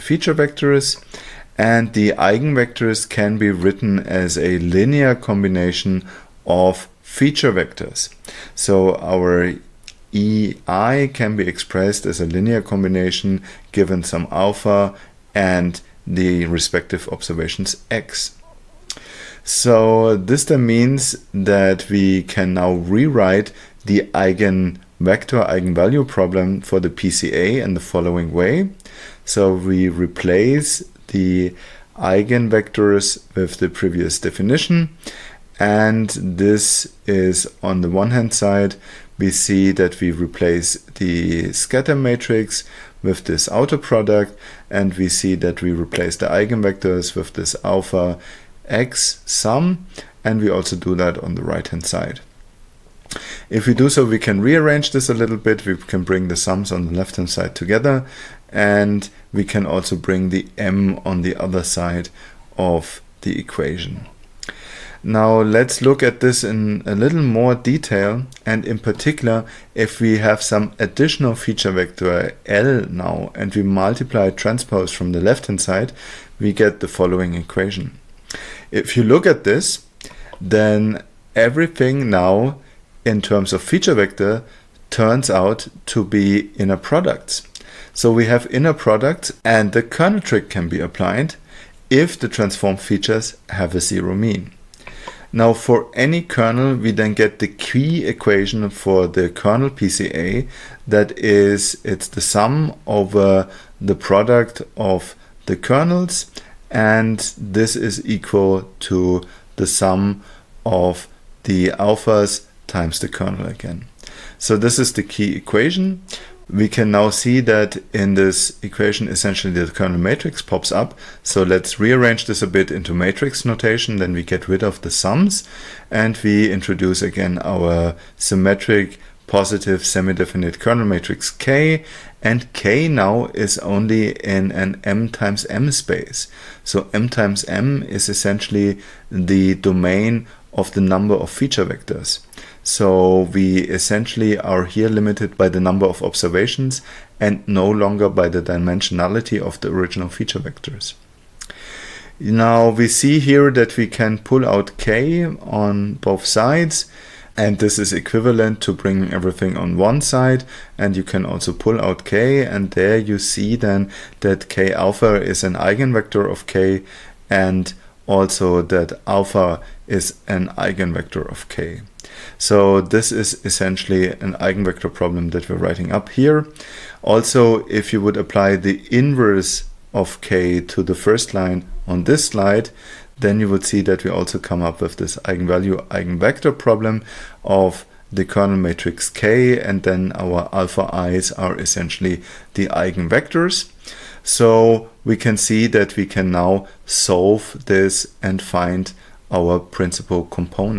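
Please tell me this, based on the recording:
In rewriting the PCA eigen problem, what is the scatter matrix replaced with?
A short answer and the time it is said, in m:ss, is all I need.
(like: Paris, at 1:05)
outer product, at 0:43.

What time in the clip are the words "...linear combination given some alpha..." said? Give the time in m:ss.
0:12.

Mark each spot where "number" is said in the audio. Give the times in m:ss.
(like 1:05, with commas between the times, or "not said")
2:20, 2:25.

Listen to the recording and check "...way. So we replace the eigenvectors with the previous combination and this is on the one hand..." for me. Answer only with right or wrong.
wrong.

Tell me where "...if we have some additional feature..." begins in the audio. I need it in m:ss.
1:09.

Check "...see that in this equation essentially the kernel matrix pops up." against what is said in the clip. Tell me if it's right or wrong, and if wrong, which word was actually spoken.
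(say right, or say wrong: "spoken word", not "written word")
right.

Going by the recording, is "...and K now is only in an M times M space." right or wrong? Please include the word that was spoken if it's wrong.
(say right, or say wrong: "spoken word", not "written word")
right.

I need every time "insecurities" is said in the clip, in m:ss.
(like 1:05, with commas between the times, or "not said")
not said.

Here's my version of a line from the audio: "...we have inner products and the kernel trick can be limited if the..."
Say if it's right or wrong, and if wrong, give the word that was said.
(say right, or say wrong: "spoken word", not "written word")
wrong: "applied", not "limited".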